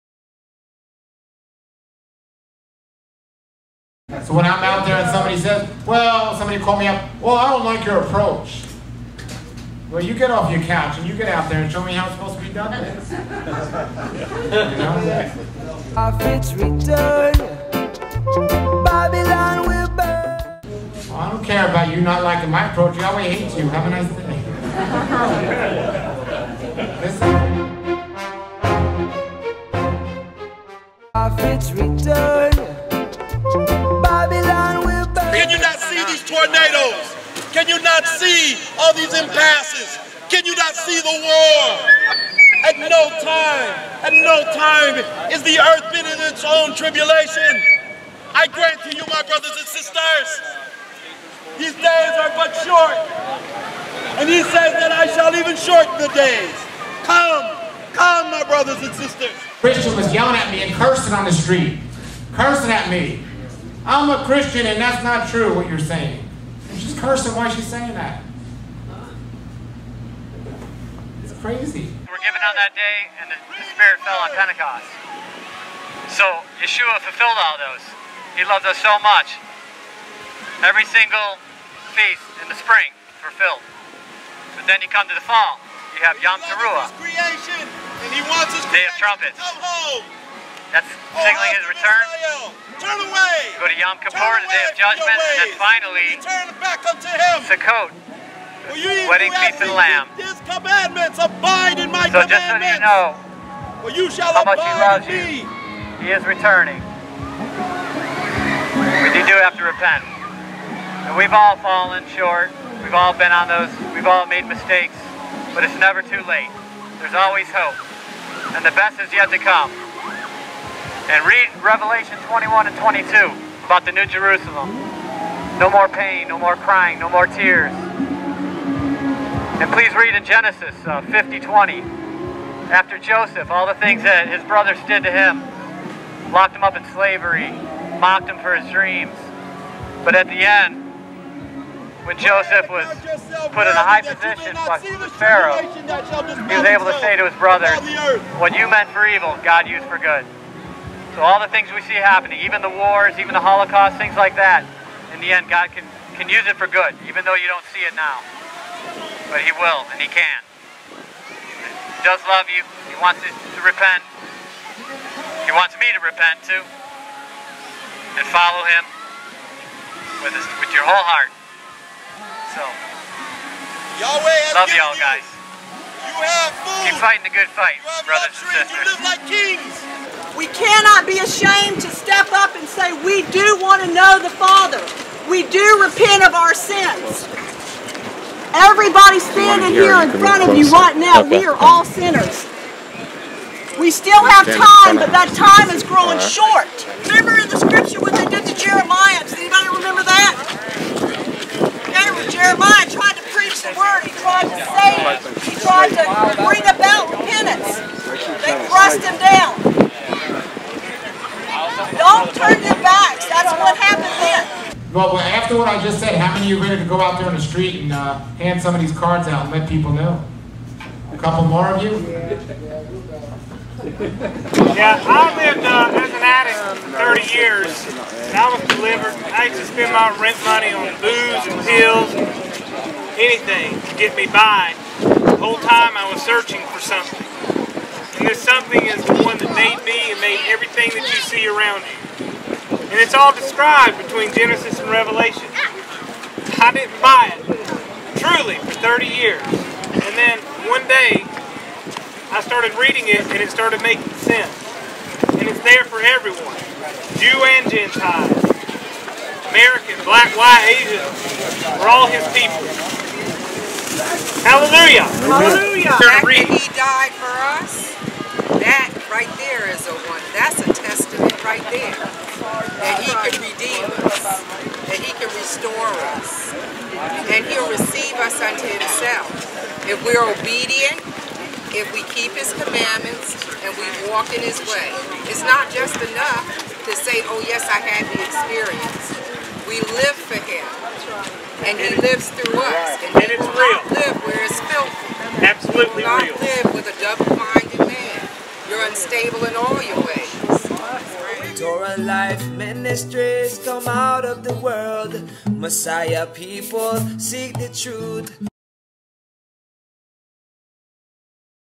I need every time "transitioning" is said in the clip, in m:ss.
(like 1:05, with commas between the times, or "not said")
not said.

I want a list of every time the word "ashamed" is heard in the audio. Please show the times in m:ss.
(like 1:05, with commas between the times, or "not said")
3:01.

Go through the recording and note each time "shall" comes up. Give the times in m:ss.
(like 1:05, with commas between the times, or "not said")
0:55, 1:44.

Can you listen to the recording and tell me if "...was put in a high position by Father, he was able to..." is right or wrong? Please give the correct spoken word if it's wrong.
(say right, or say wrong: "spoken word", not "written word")
wrong: "Pharaoh", not "Father".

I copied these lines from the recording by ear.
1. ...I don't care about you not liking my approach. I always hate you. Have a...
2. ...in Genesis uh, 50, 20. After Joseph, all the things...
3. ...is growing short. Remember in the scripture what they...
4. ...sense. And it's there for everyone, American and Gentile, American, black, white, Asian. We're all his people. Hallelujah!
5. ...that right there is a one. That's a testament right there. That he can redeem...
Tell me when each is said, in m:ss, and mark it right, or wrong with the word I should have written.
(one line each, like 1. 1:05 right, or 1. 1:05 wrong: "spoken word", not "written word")
1. 0:21 right
2. 2:10 right
3. 3:15 right
4. 4:14 wrong: "Jew", not "American"
5. 4:28 right.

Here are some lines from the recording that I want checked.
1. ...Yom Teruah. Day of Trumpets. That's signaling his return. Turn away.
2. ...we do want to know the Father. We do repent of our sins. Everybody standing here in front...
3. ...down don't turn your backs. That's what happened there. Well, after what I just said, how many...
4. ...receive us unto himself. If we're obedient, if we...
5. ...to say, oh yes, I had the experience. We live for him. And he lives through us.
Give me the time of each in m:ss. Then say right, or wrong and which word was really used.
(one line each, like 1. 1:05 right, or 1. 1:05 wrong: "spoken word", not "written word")
1. 1:26 right
2. 3:03 right
3. 3:29 right
4. 4:37 right
5. 4:46 right.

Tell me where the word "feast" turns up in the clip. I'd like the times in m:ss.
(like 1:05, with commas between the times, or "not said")
1:21, 1:39.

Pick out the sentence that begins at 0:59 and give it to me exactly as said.
Christian was yelling at me and cursing on the street, cursing at me.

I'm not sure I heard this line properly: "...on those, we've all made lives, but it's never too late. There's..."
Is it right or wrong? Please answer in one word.
wrong.